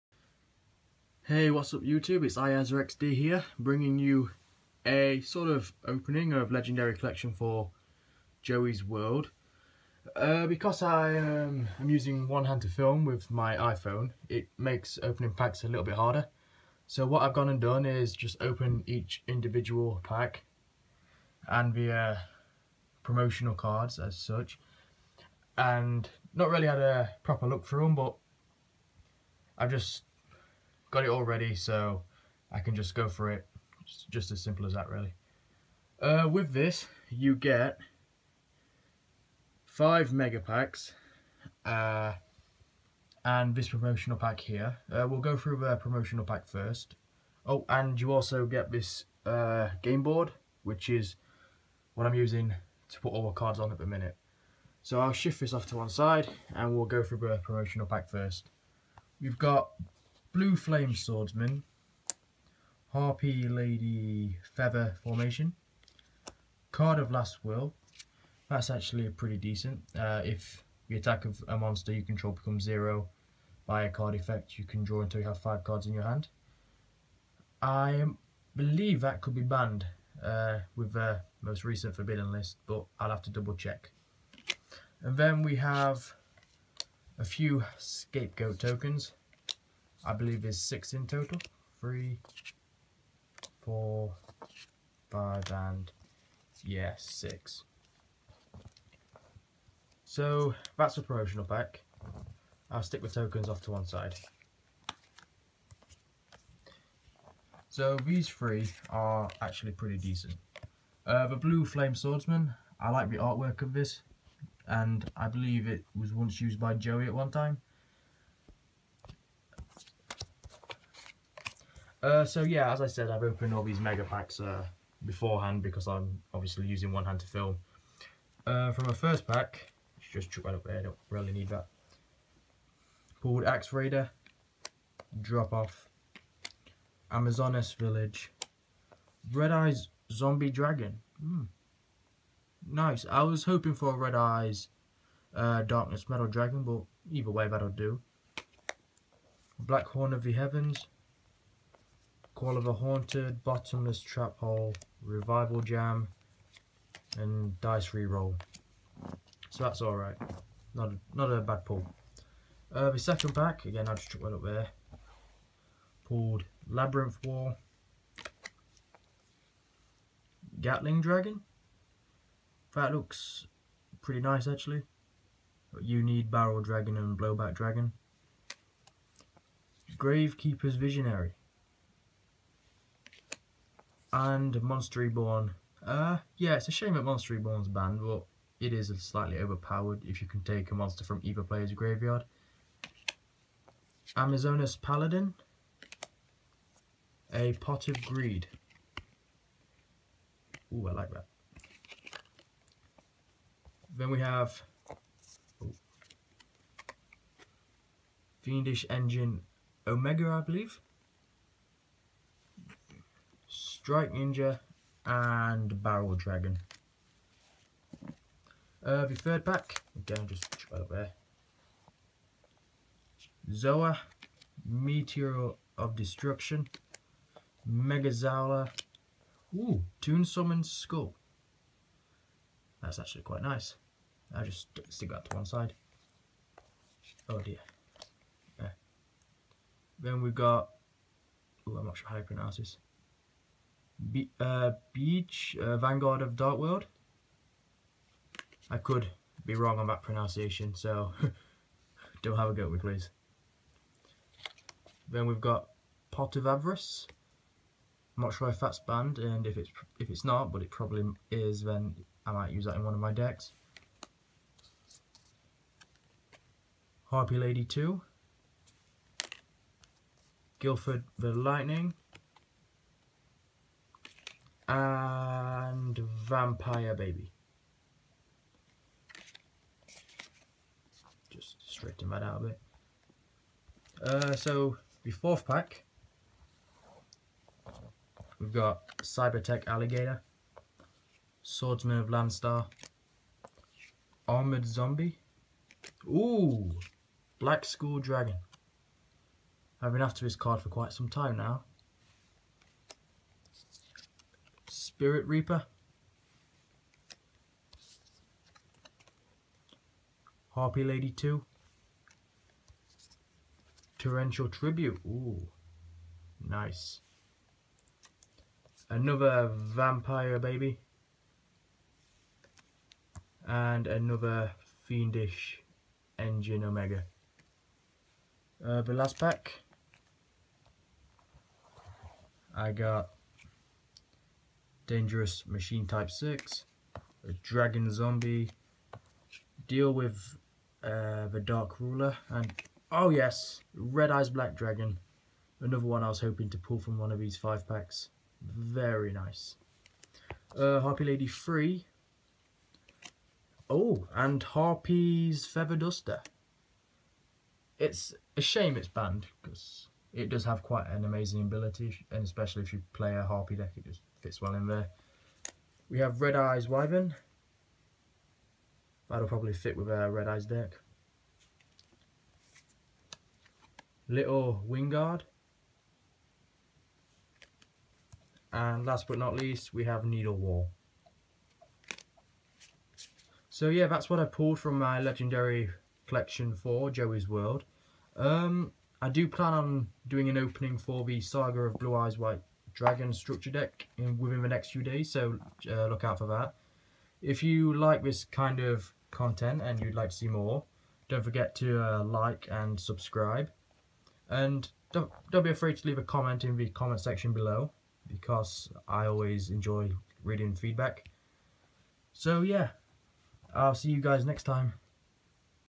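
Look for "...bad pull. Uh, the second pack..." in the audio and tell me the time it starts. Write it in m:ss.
2:41.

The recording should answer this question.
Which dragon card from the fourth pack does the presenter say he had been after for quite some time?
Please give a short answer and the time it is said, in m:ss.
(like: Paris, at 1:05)
Black Skull Dragon, at 4:57.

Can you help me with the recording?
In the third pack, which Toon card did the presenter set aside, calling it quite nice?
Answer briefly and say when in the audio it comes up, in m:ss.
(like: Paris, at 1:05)
Toon Summon Skull, at 3:50.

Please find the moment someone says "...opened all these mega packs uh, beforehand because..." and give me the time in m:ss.
2:03.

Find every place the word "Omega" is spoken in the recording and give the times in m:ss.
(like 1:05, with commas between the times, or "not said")
3:29, 5:26.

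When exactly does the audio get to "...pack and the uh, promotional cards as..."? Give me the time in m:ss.
0:20.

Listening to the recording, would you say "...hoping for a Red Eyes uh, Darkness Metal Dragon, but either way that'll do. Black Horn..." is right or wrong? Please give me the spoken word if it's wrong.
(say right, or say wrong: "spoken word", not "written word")
right.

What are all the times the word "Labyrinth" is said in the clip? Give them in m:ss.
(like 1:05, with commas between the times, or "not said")
2:46.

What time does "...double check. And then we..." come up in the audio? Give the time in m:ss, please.
1:23.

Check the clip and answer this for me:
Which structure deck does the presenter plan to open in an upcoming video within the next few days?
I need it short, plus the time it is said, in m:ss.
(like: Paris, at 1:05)
Saga of Blue Eyes White Dragon, at 6:31.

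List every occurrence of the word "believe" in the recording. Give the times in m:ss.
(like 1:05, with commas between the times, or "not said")
1:18, 1:30, 1:55, 3:30.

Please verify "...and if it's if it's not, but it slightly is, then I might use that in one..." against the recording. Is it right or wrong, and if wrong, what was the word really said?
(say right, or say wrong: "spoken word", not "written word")
wrong: "probably", not "slightly".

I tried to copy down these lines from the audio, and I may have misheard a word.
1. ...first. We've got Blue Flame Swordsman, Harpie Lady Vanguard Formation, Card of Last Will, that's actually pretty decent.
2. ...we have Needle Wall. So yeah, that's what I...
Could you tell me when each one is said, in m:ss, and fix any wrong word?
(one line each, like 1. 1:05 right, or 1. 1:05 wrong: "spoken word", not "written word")
1. 0:58 wrong: "Feather", not "Vanguard"
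2. 6:19 right.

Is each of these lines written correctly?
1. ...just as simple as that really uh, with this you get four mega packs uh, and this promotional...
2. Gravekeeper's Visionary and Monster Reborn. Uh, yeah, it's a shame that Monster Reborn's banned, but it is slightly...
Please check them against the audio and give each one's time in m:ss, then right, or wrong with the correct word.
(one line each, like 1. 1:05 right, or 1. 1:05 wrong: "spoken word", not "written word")
1. 0:34 wrong: "five", not "four"
2. 2:59 right.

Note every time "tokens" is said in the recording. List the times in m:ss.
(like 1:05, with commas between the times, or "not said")
1:28, 1:43.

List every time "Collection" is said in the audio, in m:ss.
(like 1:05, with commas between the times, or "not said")
0:06, 6:26.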